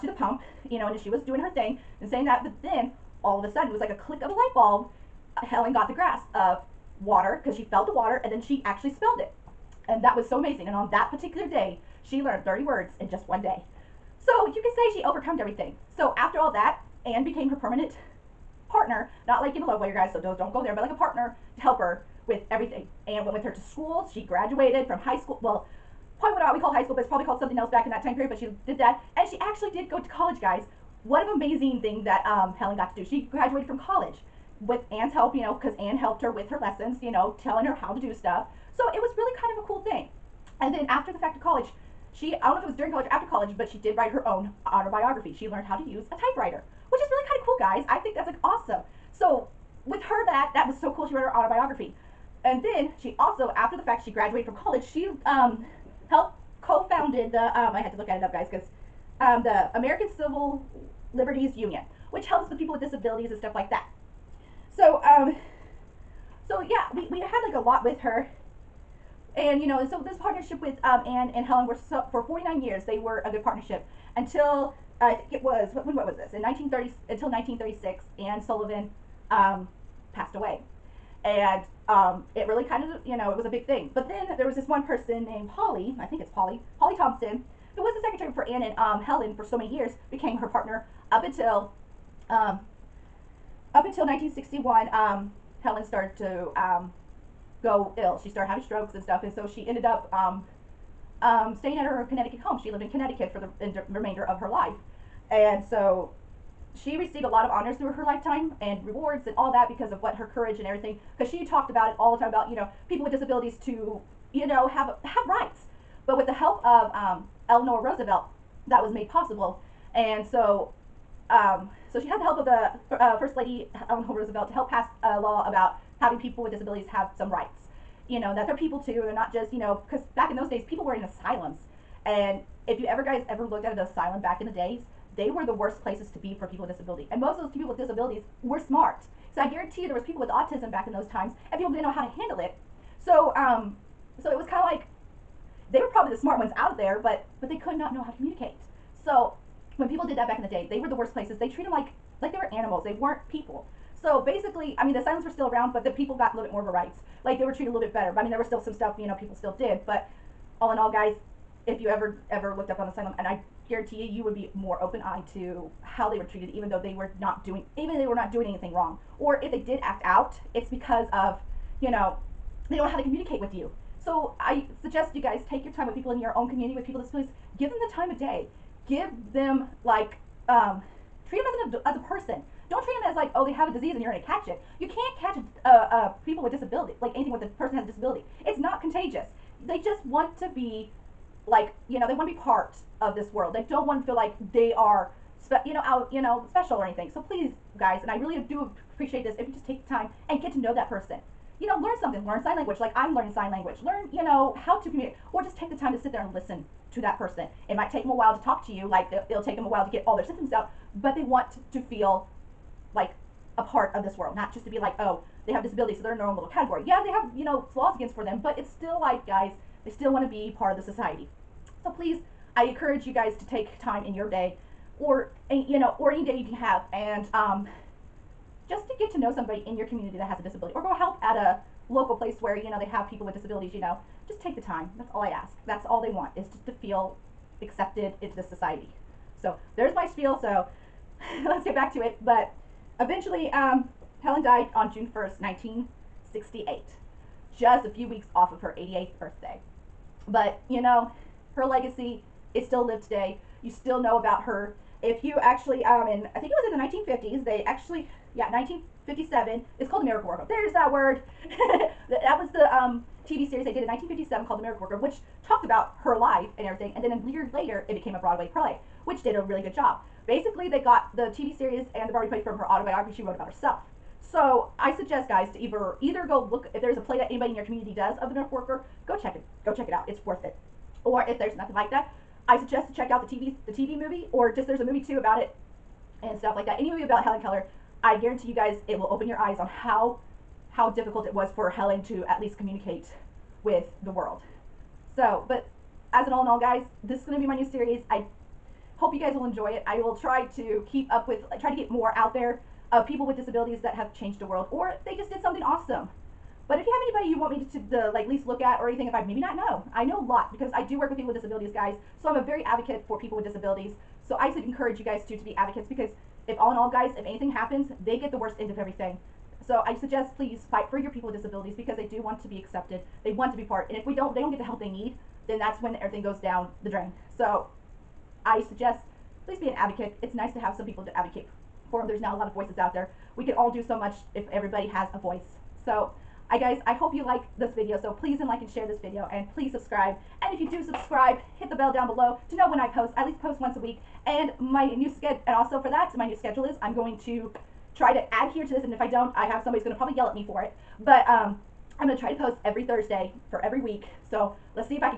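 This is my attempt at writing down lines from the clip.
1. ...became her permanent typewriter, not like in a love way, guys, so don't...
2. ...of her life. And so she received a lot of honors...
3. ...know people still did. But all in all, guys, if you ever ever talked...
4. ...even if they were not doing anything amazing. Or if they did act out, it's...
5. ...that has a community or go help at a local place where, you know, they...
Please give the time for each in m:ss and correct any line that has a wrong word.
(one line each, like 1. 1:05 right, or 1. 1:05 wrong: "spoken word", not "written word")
1. 0:17 wrong: "partner", not "typewriter"
2. 1:44 right
3. 2:39 wrong: "looked", not "talked"
4. 2:47 wrong: "wrong", not "amazing"
5. 3:50 wrong: "disability", not "community".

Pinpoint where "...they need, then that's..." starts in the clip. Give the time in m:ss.
5:24.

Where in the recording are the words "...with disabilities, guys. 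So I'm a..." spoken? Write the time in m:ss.
5:11.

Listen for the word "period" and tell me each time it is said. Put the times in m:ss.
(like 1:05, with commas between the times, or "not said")
0:28.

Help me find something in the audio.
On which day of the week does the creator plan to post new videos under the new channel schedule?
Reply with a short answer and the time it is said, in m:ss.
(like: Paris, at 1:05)
Thursday, at 5:52.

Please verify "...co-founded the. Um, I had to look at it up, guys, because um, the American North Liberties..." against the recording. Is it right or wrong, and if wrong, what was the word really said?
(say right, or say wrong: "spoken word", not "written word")
wrong: "Civil", not "North".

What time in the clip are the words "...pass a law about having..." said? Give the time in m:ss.
2:04.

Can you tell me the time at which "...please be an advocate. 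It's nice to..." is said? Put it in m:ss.
5:29.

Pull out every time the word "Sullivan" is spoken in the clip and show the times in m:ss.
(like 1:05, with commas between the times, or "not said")
1:18.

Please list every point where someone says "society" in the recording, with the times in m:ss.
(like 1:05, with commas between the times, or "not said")
3:40, 3:58.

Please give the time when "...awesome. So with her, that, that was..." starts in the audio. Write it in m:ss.
0:48.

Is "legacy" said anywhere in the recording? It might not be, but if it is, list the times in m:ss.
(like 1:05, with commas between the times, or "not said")
4:11.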